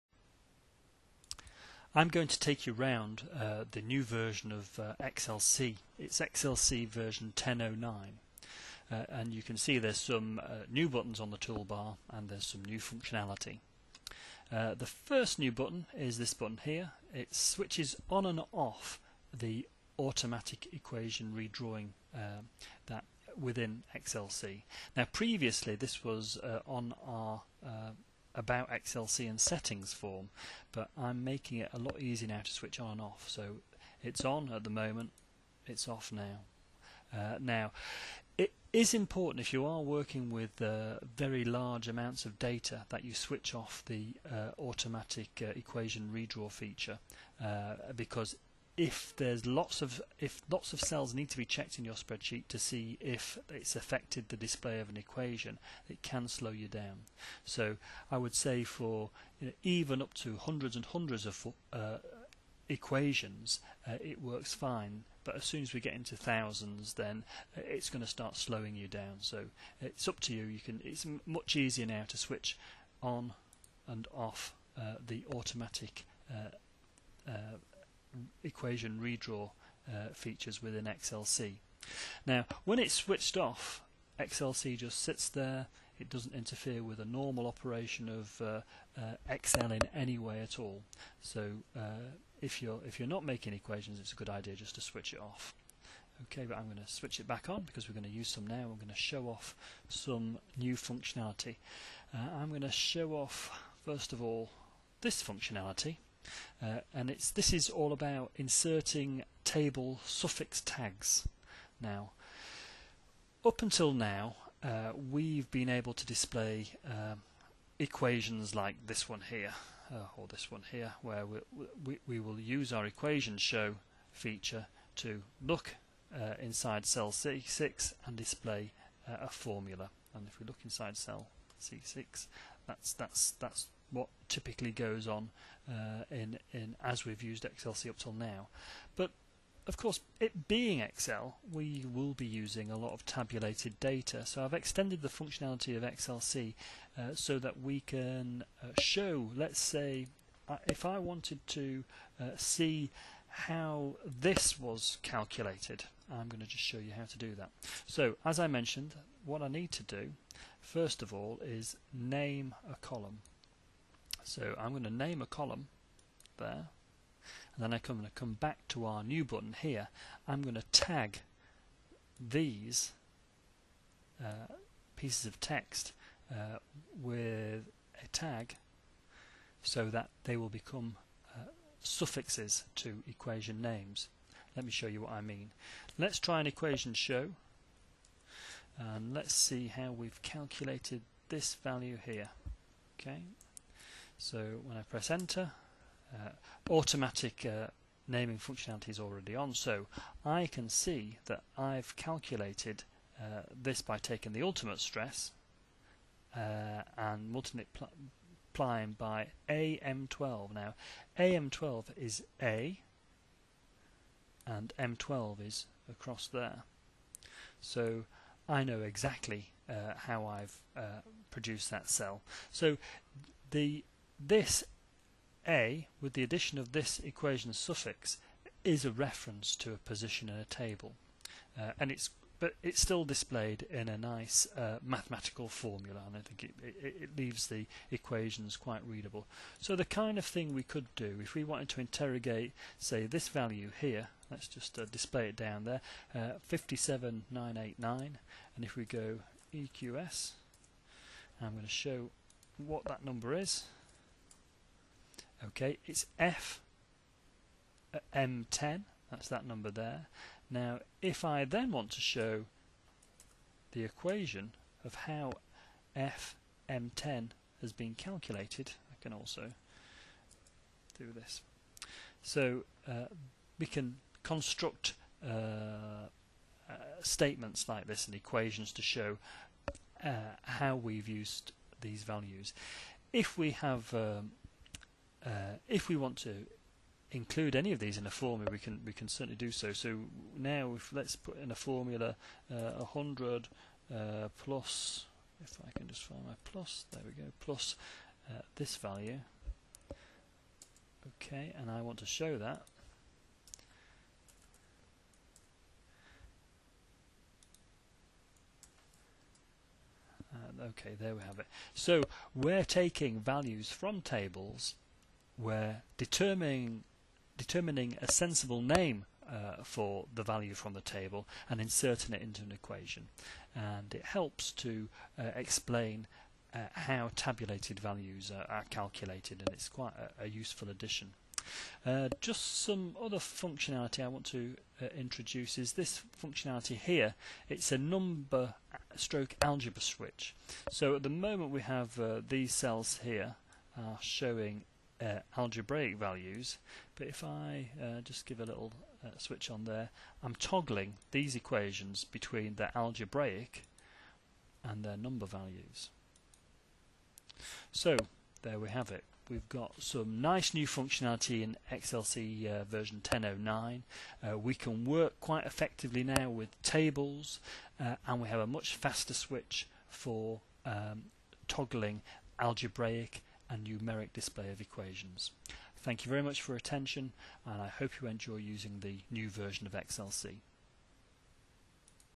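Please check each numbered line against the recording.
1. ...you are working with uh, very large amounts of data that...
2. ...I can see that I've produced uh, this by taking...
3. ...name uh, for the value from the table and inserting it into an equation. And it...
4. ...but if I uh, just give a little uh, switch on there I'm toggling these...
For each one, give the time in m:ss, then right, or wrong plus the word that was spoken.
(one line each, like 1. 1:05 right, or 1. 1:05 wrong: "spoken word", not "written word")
1. 0:39 right
2. 3:20 wrong: "calculated", not "produced"
3. 5:18 right
4. 5:46 right.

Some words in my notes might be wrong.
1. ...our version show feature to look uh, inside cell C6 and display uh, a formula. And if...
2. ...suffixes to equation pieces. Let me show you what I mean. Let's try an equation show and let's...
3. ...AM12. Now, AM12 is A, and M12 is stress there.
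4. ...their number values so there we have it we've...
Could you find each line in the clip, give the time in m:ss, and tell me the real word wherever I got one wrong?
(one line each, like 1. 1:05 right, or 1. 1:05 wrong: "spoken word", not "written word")
1. 2:02 wrong: "equation", not "version"
2. 3:01 wrong: "names", not "pieces"
3. 3:29 wrong: "across", not "stress"
4. 5:54 right.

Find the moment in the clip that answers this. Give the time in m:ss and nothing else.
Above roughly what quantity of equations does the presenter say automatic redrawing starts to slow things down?
1:06.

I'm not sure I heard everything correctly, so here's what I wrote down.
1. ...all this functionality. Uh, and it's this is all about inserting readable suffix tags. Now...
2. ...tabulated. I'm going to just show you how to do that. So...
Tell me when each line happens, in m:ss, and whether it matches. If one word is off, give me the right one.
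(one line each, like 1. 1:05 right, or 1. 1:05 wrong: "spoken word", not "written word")
1. 1:44 wrong: "table", not "readable"
2. 2:35 wrong: "calculated", not "tabulated".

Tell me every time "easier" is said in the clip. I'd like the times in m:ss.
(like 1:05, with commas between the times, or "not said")
0:31, 1:11.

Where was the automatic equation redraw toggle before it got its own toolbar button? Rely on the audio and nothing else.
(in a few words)
about XLC and settings form.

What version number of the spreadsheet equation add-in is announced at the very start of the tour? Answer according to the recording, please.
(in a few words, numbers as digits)
1009.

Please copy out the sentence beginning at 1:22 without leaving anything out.
Now, when it's switched off, XLC just sits there.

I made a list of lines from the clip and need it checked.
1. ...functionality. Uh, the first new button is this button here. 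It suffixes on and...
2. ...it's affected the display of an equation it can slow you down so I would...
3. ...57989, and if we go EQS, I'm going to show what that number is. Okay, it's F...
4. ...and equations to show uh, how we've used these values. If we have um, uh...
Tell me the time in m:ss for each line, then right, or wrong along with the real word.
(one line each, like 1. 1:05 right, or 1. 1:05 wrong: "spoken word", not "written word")
1. 0:12 wrong: "switches", not "suffixes"
2. 0:53 right
3. 4:06 right
4. 4:38 right.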